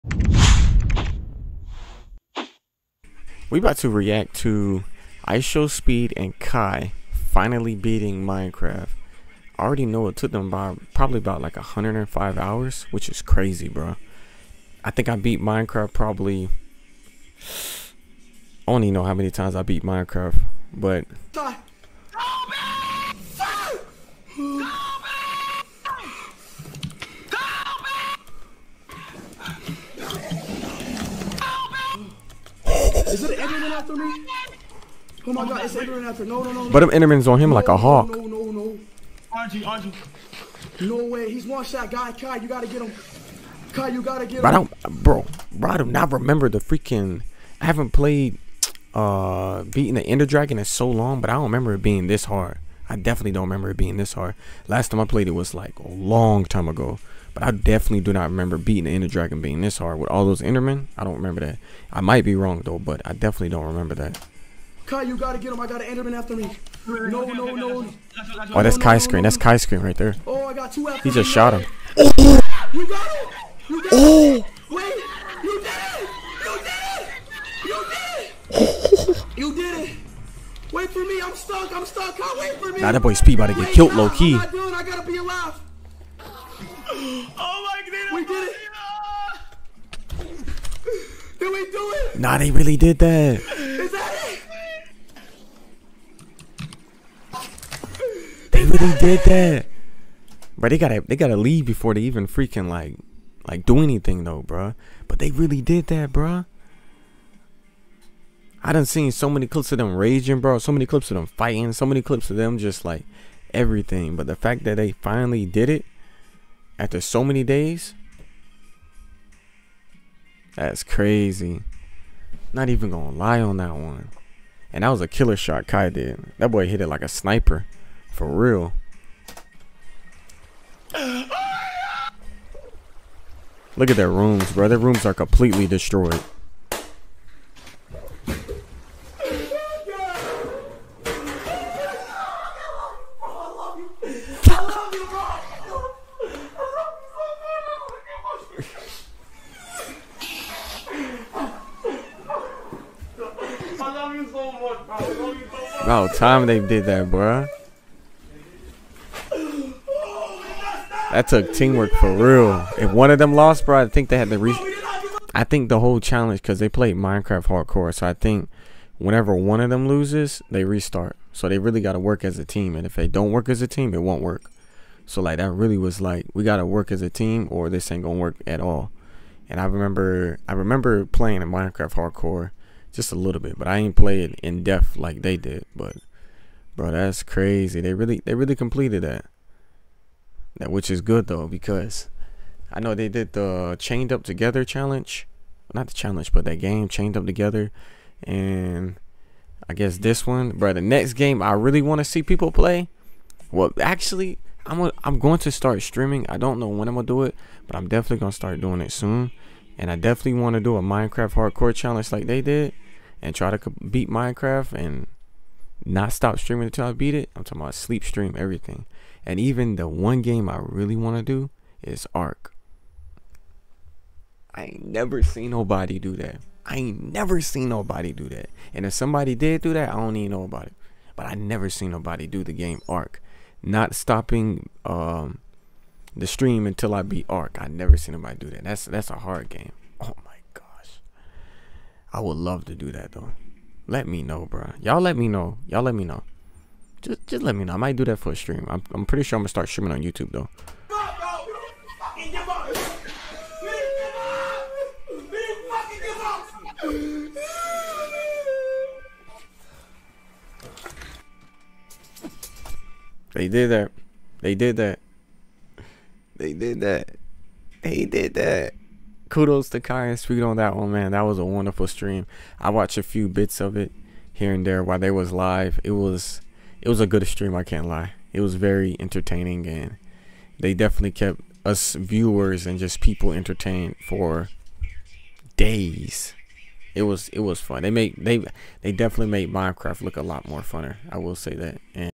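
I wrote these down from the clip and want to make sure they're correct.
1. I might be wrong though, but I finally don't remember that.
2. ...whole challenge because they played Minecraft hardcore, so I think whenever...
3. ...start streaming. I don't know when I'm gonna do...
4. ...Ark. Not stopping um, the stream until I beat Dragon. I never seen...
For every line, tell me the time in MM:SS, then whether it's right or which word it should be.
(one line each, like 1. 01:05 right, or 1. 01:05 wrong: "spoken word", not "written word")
1. 01:01 wrong: "definitely", not "finally"
2. 02:45 right
3. 03:25 right
4. 03:52 wrong: "Ark", not "Dragon".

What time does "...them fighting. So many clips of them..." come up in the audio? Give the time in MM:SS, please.
01:51.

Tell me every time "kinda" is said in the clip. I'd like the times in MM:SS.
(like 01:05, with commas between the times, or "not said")
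not said.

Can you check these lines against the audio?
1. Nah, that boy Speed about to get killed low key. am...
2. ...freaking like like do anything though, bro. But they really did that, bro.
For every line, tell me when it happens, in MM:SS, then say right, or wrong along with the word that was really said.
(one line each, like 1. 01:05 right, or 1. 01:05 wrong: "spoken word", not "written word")
1. 01:22 right
2. 01:42 right.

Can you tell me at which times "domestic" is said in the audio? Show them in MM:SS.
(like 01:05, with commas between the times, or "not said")
not said.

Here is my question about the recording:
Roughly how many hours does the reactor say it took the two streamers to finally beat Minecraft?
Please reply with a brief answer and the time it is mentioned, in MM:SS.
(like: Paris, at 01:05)
105 hours, at 00:11.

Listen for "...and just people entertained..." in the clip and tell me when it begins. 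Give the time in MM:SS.
04:42.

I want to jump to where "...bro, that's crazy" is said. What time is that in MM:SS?
03:06.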